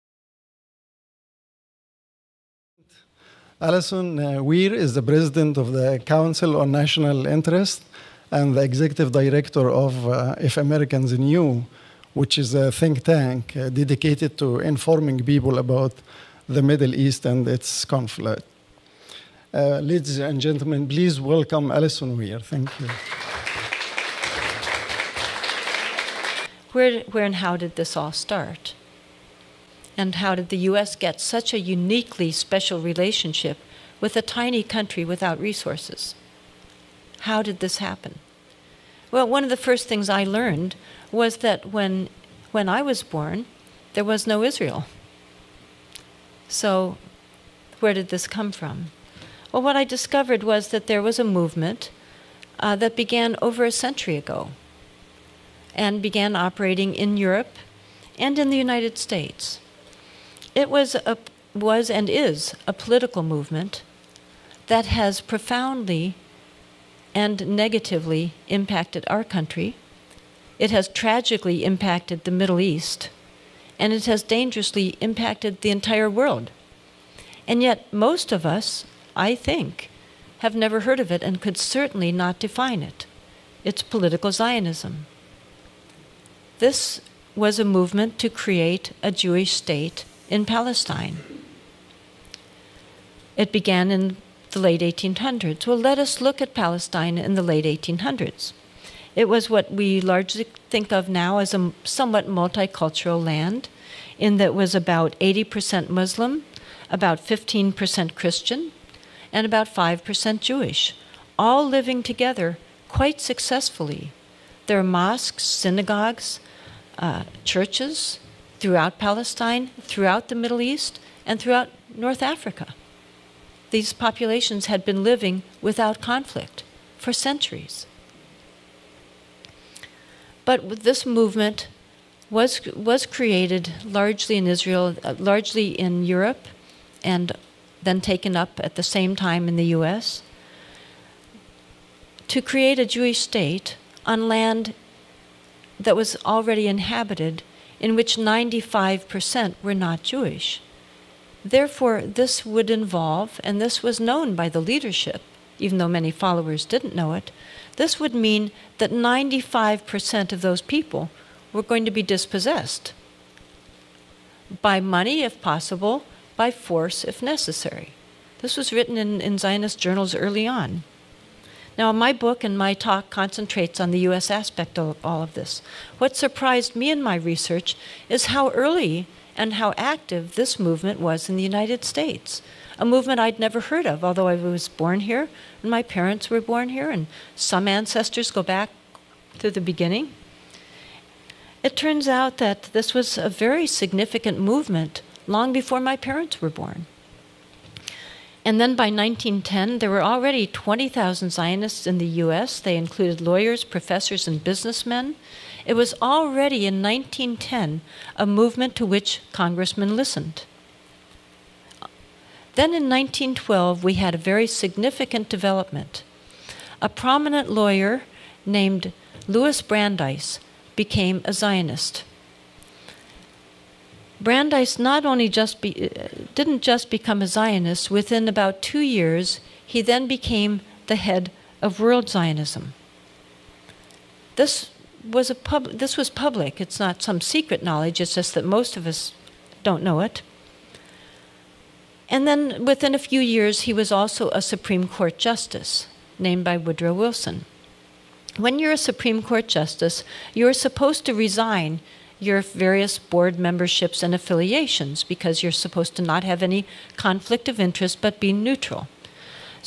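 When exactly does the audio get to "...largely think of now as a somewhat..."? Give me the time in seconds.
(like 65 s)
100 s.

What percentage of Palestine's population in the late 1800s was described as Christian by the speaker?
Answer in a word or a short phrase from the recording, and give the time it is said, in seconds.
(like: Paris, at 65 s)
15%, at 106 s.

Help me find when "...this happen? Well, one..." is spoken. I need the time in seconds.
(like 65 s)
37 s.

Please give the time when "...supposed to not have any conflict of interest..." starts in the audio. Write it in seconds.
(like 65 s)
255 s.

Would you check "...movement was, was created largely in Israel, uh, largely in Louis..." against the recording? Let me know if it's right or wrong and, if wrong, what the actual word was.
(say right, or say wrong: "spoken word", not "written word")
wrong: "Europe", not "Louis".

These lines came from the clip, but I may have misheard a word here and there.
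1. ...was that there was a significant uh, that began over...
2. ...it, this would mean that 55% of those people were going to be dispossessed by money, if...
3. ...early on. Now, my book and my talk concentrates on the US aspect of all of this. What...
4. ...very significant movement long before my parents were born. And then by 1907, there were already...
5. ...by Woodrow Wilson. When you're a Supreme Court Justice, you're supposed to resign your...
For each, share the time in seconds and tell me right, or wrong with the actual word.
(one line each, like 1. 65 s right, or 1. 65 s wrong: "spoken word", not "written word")
1. 50 s wrong: "movement", not "significant"
2. 157 s wrong: "95", not "55"
3. 170 s right
4. 193 s wrong: "1910", not "1907"
5. 246 s right.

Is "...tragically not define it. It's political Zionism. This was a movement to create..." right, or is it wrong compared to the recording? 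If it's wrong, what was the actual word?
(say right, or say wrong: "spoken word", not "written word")
wrong: "certainly", not "tragically".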